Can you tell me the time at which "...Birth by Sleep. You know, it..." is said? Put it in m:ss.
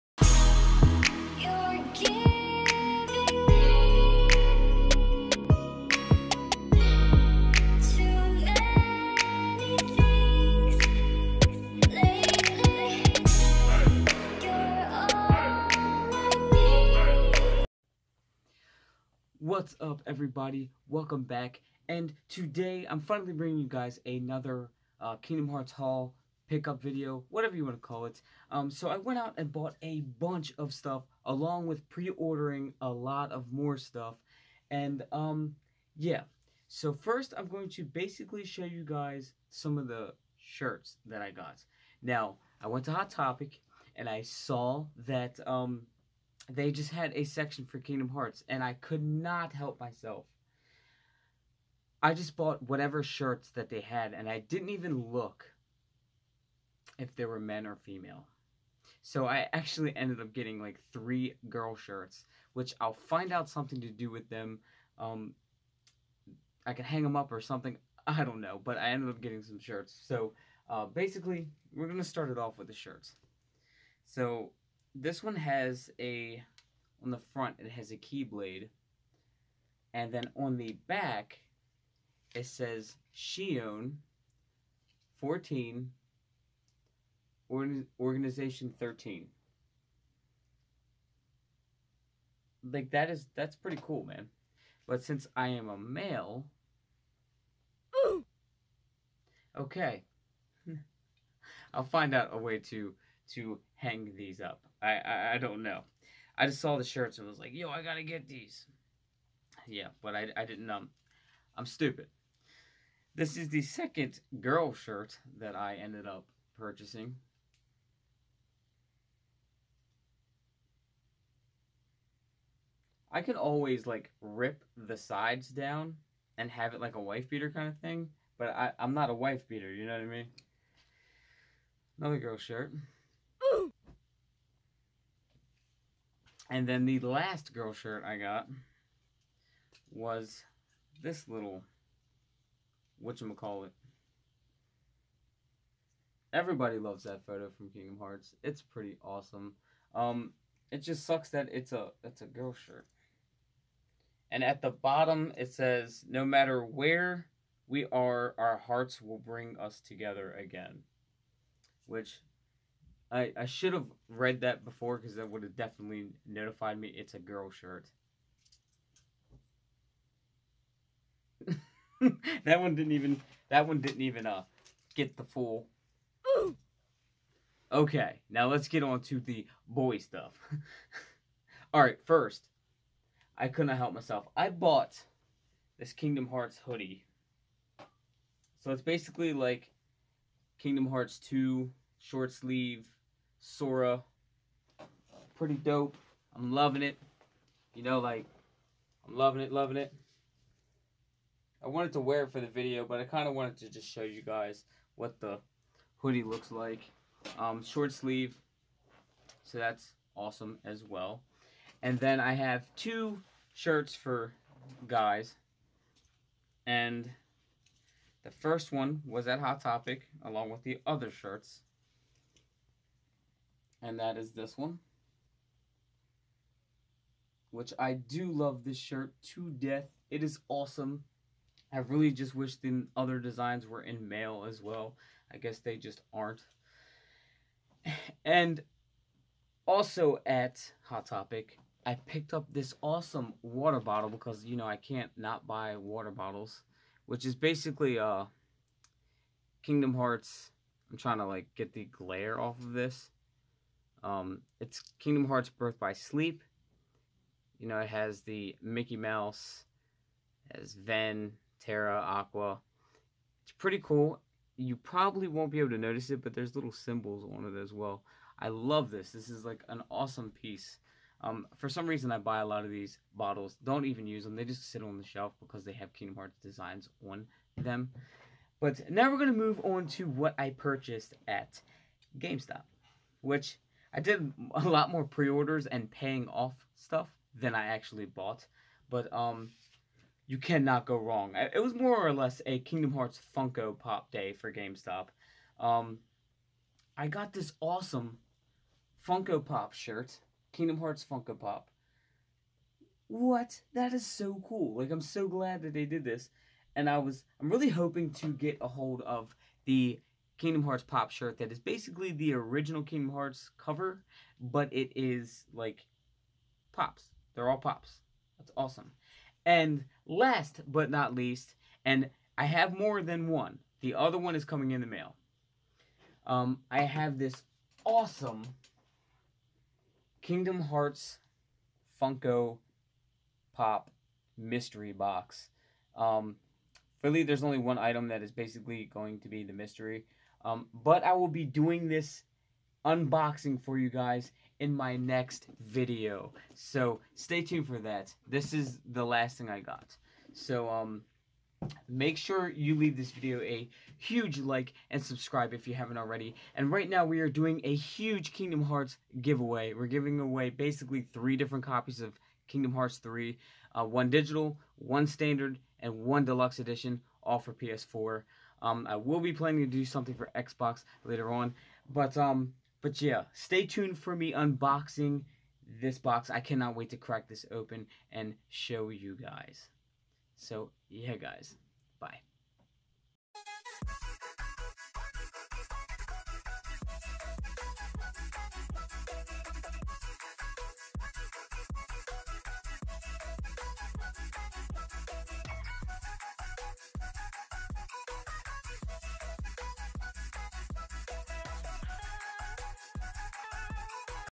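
4:15.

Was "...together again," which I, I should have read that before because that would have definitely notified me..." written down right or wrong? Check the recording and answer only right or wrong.
right.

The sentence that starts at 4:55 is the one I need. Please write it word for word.
Um, I got this awesome Funko Pop shirt, Kingdom Hearts Funko Pop.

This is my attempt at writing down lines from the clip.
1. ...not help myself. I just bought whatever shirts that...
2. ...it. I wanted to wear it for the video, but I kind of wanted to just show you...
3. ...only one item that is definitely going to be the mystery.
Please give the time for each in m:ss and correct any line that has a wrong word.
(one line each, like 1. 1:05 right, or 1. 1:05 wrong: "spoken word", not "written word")
1. 0:49 right
2. 3:19 right
3. 5:37 wrong: "basically", not "definitely".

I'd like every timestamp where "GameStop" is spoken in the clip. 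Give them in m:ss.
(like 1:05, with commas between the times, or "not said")
4:42, 4:54.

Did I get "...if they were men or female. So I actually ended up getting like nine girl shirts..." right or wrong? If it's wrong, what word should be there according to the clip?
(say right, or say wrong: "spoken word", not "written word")
wrong: "three", not "nine".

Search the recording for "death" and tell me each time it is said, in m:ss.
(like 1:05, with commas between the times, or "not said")
3:49.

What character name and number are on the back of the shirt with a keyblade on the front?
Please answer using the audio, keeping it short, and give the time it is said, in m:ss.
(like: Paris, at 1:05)
Xion 14, at 1:23.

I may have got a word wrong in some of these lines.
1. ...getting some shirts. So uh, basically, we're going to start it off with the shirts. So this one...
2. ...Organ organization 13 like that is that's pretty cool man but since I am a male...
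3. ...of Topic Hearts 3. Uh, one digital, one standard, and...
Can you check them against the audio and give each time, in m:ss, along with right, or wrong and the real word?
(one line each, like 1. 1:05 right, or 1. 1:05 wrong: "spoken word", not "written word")
1. 1:09 right
2. 1:27 right
3. 6:02 wrong: "Kingdom", not "Topic".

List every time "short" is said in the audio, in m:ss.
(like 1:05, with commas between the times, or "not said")
3:11, 3:27.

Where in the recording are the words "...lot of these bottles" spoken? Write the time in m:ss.
4:32.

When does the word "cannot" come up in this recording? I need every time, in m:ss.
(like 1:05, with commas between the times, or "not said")
4:50, 6:16.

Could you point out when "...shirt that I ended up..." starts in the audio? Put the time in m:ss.
1:54.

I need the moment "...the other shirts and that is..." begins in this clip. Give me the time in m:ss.
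3:40.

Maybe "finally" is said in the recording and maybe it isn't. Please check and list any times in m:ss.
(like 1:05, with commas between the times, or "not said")
0:22.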